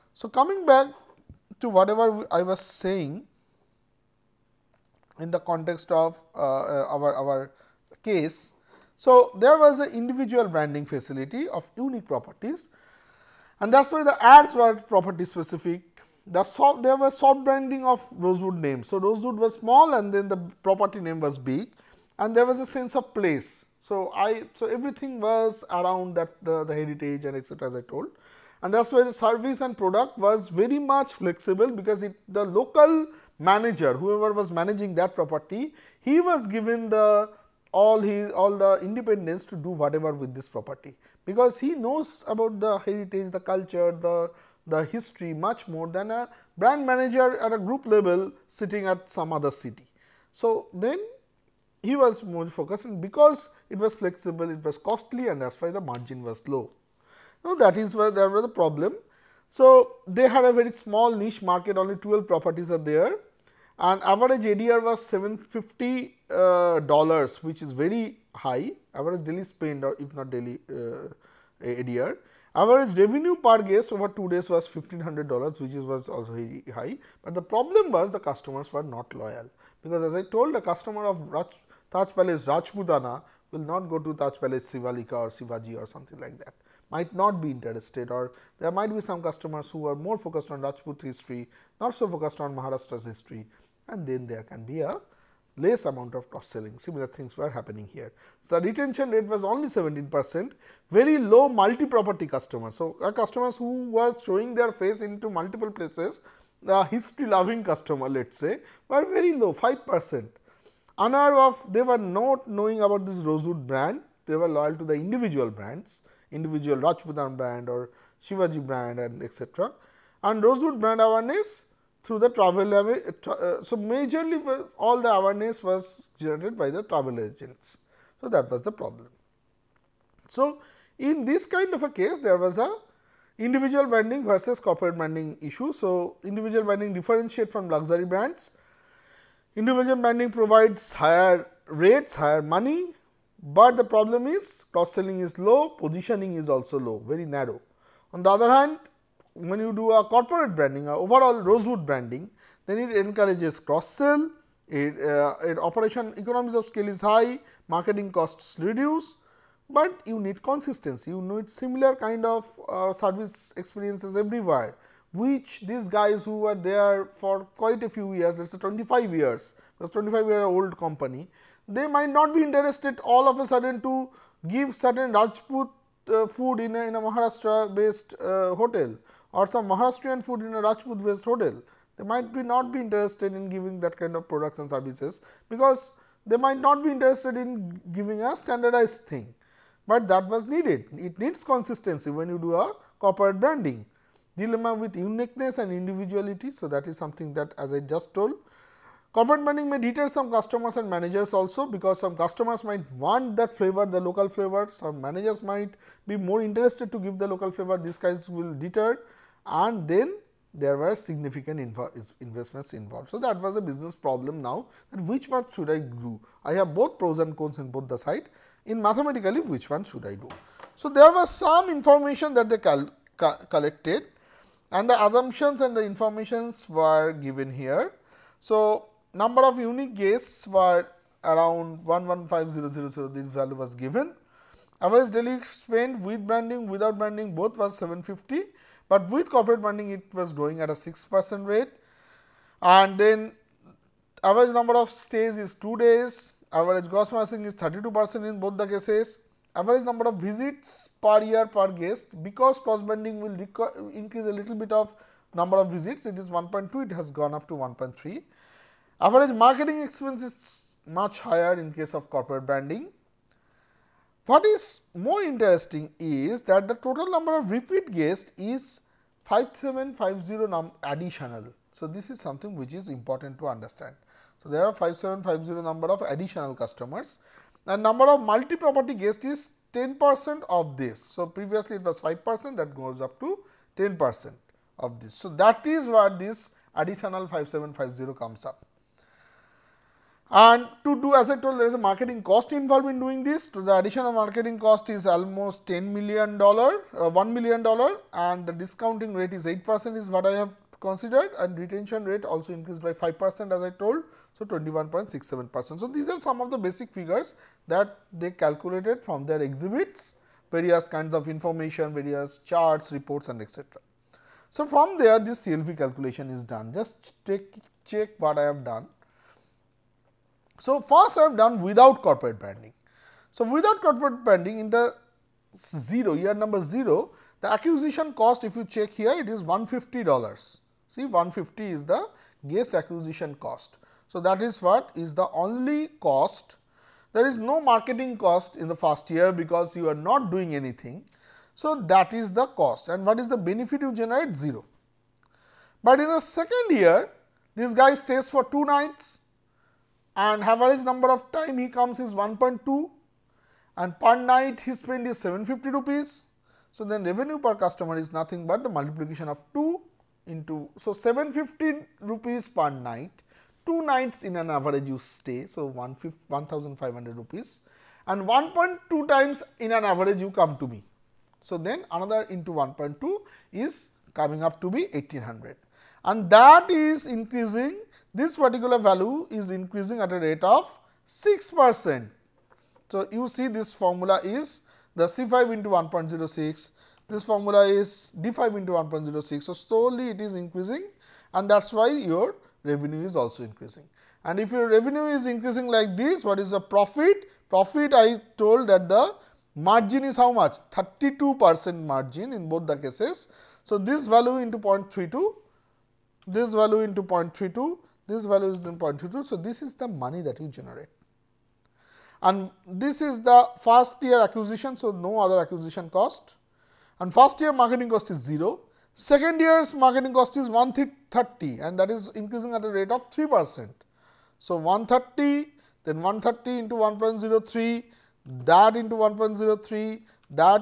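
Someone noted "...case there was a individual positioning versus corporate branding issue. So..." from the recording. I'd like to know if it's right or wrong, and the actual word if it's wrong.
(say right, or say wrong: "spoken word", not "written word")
wrong: "branding", not "positioning".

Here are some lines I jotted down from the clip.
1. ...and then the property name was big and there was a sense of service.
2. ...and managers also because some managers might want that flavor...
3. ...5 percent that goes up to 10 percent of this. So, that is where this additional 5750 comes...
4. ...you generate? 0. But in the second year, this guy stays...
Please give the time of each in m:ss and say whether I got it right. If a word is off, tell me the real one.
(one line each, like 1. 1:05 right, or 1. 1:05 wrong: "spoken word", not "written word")
1. 0:19 wrong: "place", not "service"
2. 3:20 wrong: "customers", not "managers"
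3. 4:41 right
4. 5:43 right.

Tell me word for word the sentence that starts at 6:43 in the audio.
So, this value into 0.32, this value into 0.32 this value is 0.22.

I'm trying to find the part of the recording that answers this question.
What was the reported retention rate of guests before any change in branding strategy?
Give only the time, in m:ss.
1:39.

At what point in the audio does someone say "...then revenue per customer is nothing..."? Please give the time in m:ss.
5:56.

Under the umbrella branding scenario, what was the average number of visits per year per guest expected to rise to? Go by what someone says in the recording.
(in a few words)
1.3.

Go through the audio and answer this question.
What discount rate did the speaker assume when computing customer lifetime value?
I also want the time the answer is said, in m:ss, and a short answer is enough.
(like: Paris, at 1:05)
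8 percent, at 4:59.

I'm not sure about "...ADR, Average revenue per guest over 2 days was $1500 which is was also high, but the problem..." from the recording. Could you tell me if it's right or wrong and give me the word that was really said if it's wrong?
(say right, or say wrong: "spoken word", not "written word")
right.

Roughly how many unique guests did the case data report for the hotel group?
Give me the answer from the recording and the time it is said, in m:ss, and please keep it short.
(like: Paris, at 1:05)
115000, at 3:51.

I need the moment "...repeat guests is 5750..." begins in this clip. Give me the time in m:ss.
4:27.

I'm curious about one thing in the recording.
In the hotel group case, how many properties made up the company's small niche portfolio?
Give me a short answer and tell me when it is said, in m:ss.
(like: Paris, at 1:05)
12, at 1:01.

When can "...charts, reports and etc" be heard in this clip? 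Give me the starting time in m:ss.
5:12.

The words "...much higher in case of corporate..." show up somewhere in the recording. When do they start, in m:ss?
4:20.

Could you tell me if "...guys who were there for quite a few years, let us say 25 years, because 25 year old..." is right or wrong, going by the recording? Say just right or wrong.
right.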